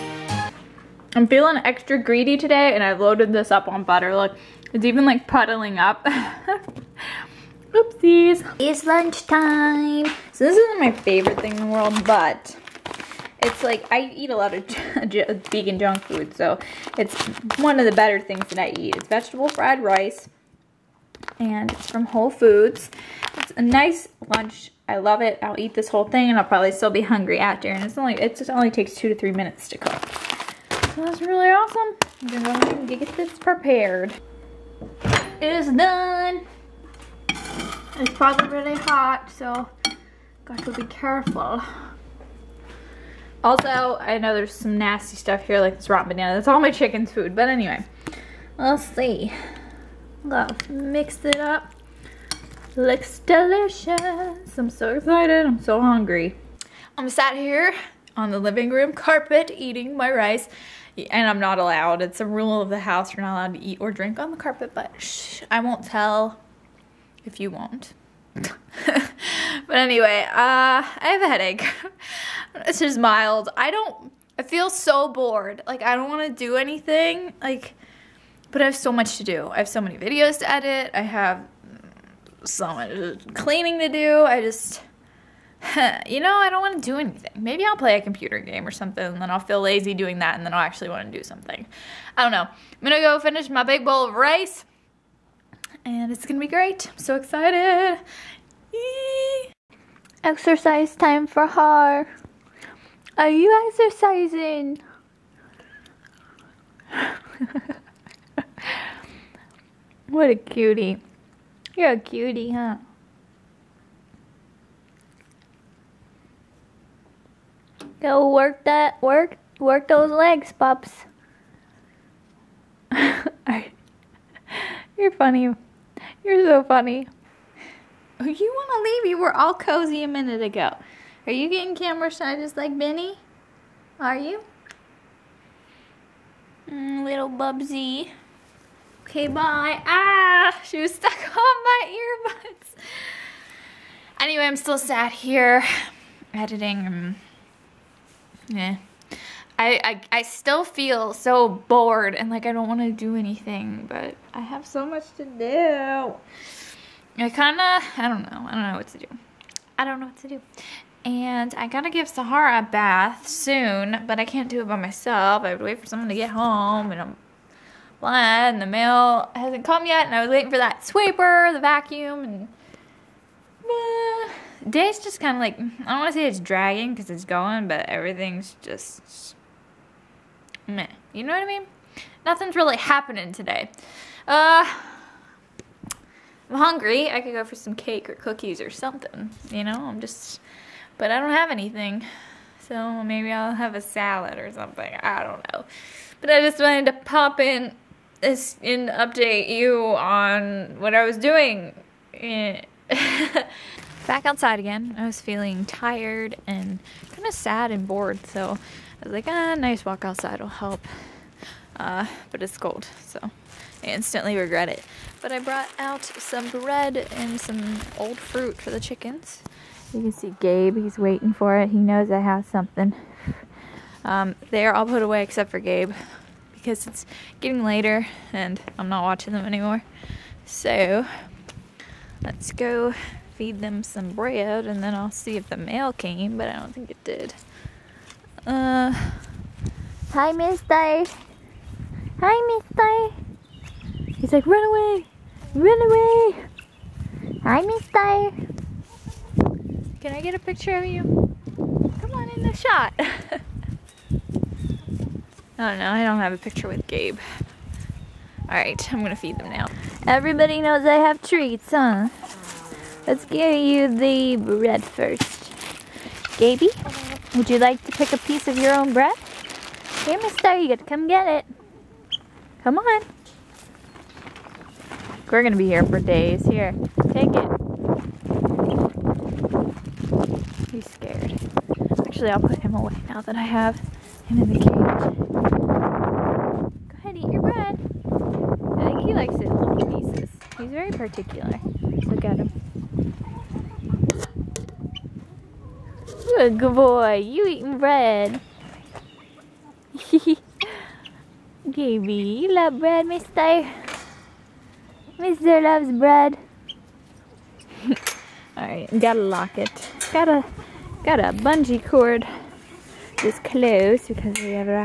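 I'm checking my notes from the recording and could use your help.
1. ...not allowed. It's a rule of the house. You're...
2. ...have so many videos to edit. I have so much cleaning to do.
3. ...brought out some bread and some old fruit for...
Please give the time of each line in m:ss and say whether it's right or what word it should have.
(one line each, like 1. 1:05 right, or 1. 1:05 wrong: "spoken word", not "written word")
1. 1:01 right
2. 1:19 right
3. 3:35 right.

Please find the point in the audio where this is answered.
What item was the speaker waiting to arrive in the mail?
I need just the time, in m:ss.
2:50.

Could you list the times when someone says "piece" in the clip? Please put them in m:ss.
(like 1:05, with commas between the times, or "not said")
4:28, 4:50.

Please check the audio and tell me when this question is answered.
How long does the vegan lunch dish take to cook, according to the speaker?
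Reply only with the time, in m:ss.
0:28.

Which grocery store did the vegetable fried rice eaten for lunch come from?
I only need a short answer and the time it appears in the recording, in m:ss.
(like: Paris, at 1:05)
Whole Foods, at 0:22.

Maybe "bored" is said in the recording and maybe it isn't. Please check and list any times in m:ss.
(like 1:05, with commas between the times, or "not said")
1:15, 2:31, 3:27.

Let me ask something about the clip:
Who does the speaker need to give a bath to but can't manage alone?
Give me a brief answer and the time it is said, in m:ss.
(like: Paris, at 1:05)
Sahara, at 2:42.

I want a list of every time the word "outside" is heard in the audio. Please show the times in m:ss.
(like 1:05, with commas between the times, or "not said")
3:24, 3:30.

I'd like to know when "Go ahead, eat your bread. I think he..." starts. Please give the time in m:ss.
4:46.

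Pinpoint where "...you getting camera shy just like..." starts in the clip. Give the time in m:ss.
2:11.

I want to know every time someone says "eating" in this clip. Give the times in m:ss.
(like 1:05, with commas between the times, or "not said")
0:59, 4:57.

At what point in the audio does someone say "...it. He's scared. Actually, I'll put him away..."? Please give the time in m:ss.
4:37.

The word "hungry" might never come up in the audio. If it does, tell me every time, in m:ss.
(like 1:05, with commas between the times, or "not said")
0:27, 0:55, 3:06.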